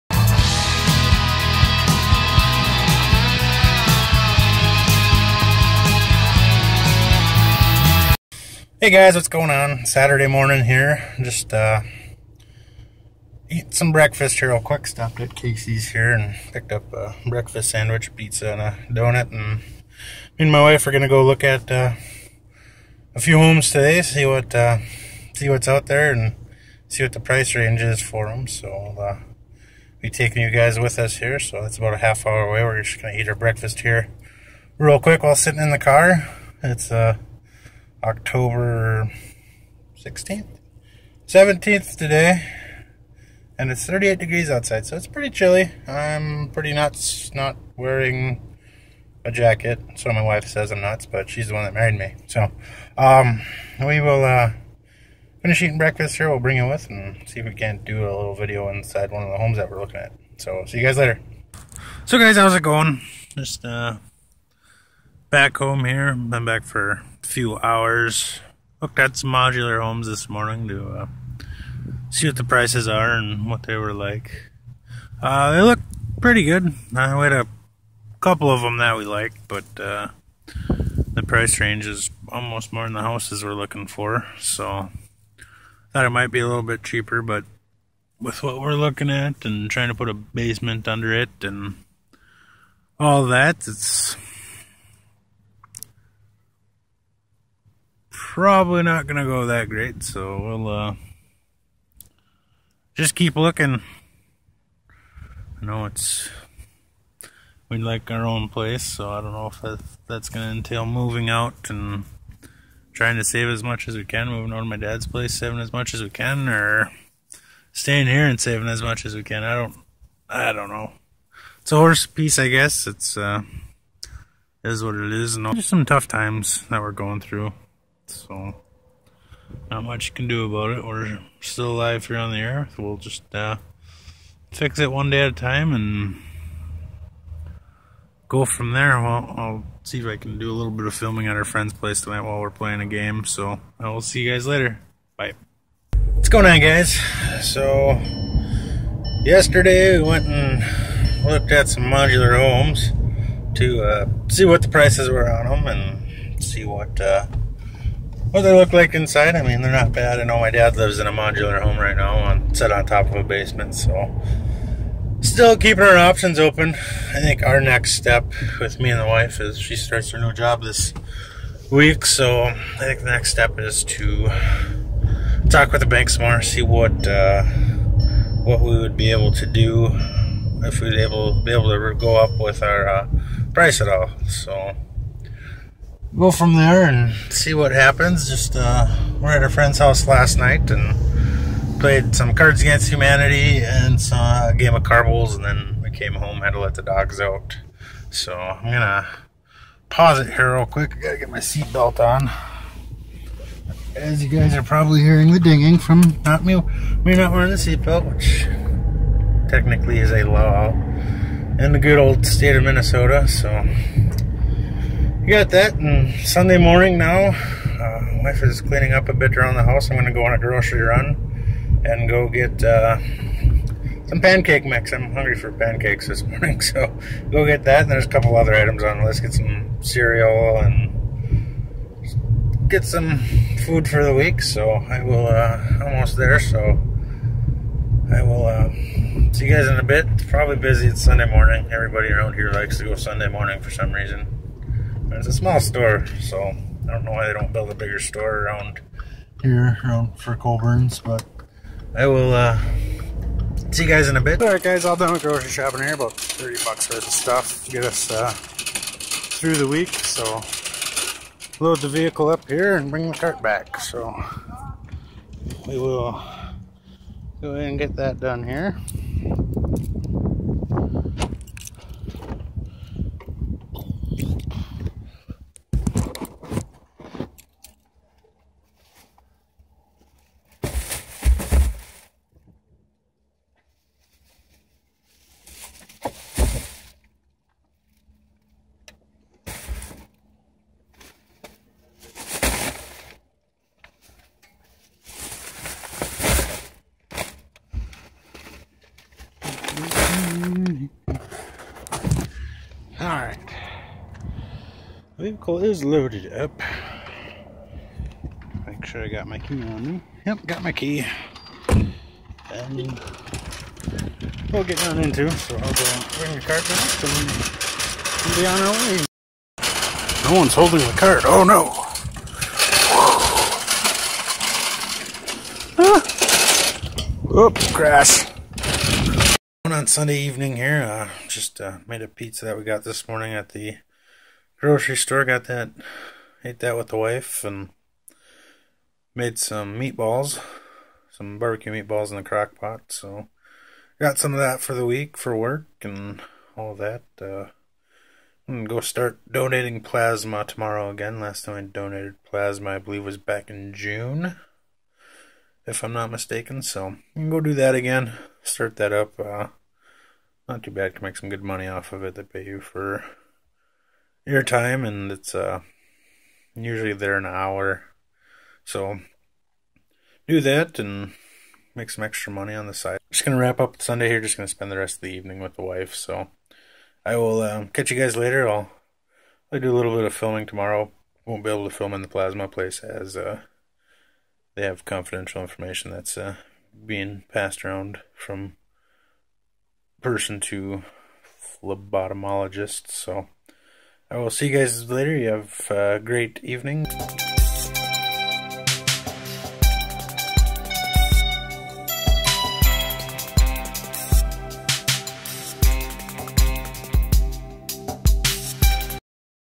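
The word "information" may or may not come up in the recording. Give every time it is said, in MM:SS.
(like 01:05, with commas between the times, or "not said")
06:25.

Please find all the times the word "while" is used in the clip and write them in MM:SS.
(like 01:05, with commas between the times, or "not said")
00:35, 02:22.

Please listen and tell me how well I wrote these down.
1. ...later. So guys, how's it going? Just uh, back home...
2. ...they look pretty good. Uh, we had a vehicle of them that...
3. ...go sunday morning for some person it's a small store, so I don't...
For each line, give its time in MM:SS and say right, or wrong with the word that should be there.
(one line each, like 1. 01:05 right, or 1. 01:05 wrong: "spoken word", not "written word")
1. 01:00 right
2. 01:15 wrong: "couple", not "vehicle"
3. 04:02 wrong: "reason", not "person".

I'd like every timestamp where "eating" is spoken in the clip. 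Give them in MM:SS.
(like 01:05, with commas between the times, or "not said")
00:55.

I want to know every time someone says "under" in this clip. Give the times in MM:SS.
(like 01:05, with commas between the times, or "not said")
01:30.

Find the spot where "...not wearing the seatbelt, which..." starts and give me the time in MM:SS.
03:27.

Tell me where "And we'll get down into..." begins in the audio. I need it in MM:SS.
05:11.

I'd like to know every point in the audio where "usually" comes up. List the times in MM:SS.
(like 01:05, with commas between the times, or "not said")
06:06.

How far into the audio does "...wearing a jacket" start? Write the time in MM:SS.
00:47.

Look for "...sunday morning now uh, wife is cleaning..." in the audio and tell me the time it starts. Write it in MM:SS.
03:36.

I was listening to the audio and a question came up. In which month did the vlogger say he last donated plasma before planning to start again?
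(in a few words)
June.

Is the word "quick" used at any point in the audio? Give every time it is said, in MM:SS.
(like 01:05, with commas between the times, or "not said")
00:14, 00:34, 03:20.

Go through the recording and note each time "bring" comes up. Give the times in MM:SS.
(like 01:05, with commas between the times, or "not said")
00:56, 04:22, 05:16.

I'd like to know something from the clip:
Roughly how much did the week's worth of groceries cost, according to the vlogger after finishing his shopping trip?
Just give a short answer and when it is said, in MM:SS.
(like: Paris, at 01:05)
$30, at 04:16.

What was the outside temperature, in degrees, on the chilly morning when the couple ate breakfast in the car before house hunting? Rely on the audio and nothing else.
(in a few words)
38.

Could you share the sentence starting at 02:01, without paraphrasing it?
It's a horse piece, I guess.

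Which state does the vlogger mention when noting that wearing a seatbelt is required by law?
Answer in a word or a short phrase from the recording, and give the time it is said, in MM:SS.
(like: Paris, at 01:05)
Minnesota, at 03:32.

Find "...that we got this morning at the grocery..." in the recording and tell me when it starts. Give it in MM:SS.
05:32.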